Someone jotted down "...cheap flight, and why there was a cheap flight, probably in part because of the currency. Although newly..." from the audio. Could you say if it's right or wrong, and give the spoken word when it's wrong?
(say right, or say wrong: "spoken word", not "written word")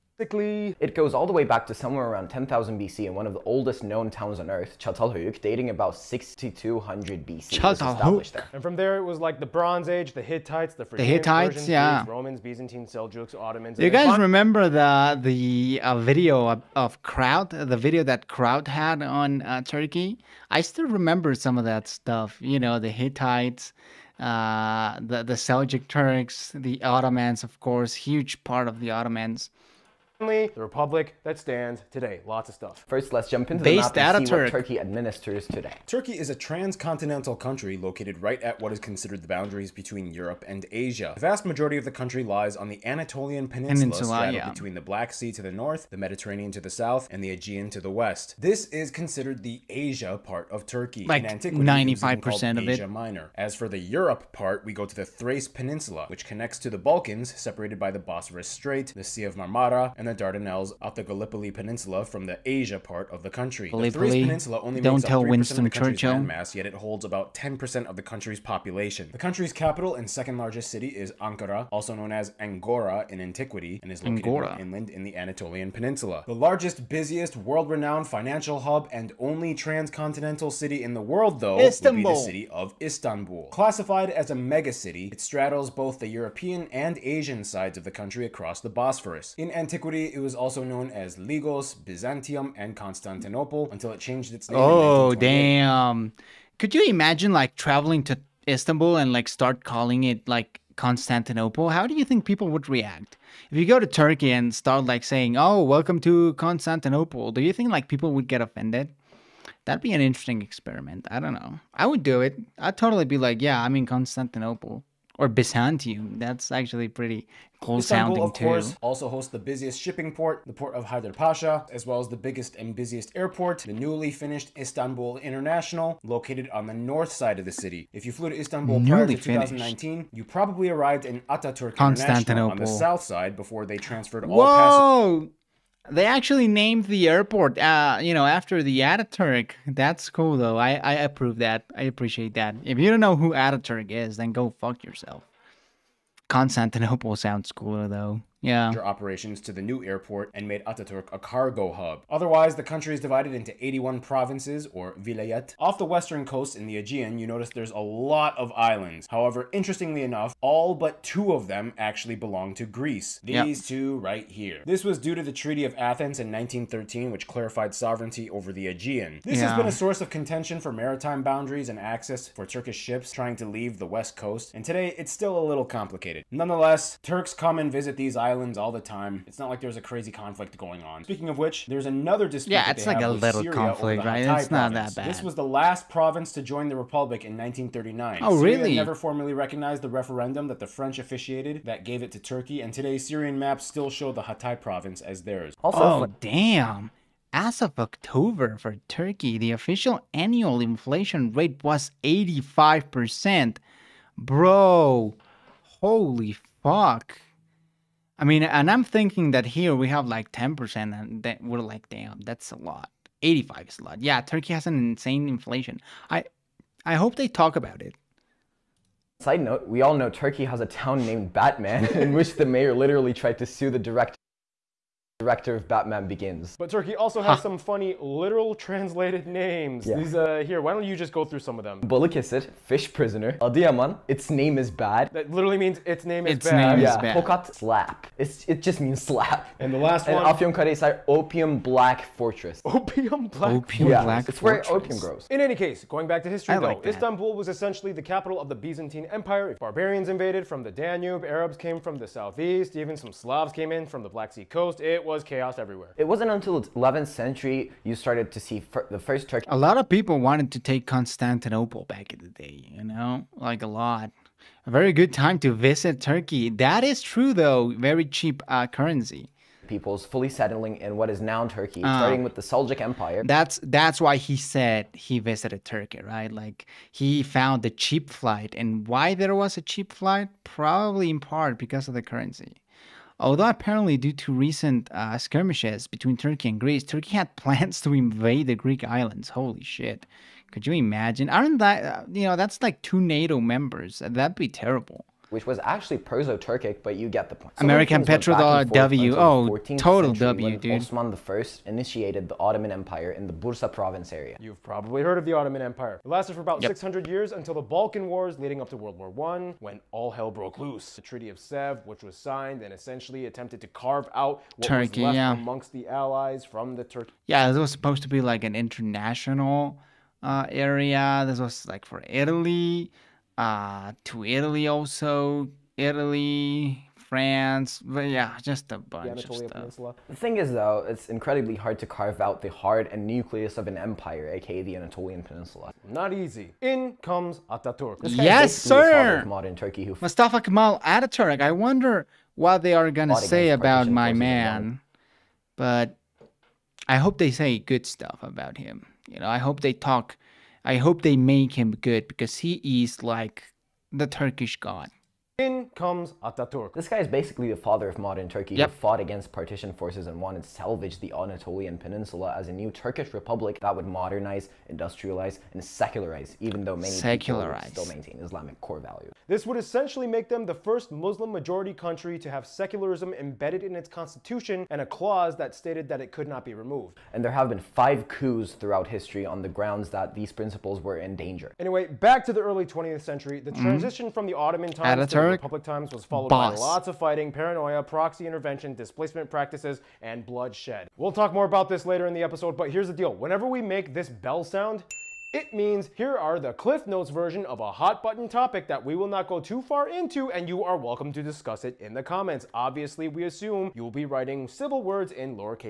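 wrong: "apparently", not "newly".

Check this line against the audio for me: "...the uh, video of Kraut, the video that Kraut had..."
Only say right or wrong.
right.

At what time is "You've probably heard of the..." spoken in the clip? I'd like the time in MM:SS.
05:04.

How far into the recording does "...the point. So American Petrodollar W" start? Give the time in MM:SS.
04:57.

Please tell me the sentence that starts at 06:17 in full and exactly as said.
And there have been five coups throughout history on the grounds that these principles were in danger.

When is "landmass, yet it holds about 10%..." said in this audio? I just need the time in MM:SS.
01:06.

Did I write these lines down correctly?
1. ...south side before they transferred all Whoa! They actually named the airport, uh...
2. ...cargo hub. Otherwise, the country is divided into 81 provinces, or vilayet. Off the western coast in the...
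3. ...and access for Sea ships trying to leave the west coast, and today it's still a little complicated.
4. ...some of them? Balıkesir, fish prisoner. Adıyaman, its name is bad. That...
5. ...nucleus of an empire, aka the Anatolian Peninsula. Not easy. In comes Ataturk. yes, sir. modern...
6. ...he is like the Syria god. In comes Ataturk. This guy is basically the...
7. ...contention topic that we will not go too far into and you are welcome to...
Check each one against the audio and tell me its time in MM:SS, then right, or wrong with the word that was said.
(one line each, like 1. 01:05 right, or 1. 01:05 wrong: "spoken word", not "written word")
1. 02:12 right
2. 02:31 right
3. 02:51 wrong: "Turkish", not "Sea"
4. 03:51 right
5. 05:33 right
6. 05:52 wrong: "Turkish", not "Syria"
7. 06:38 wrong: "button", not "contention".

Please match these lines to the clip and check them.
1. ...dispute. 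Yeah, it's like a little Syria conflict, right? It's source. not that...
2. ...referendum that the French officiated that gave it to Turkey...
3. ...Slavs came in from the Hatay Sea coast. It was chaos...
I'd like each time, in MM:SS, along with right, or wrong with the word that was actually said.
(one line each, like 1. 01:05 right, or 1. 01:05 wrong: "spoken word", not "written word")
1. 03:02 wrong: "province", not "source"
2. 03:09 right
3. 04:13 wrong: "Black", not "Hatay".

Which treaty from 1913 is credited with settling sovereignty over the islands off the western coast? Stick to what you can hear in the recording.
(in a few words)
Treaty of Athens.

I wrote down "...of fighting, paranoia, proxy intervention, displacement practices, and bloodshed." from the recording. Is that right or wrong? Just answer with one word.
right.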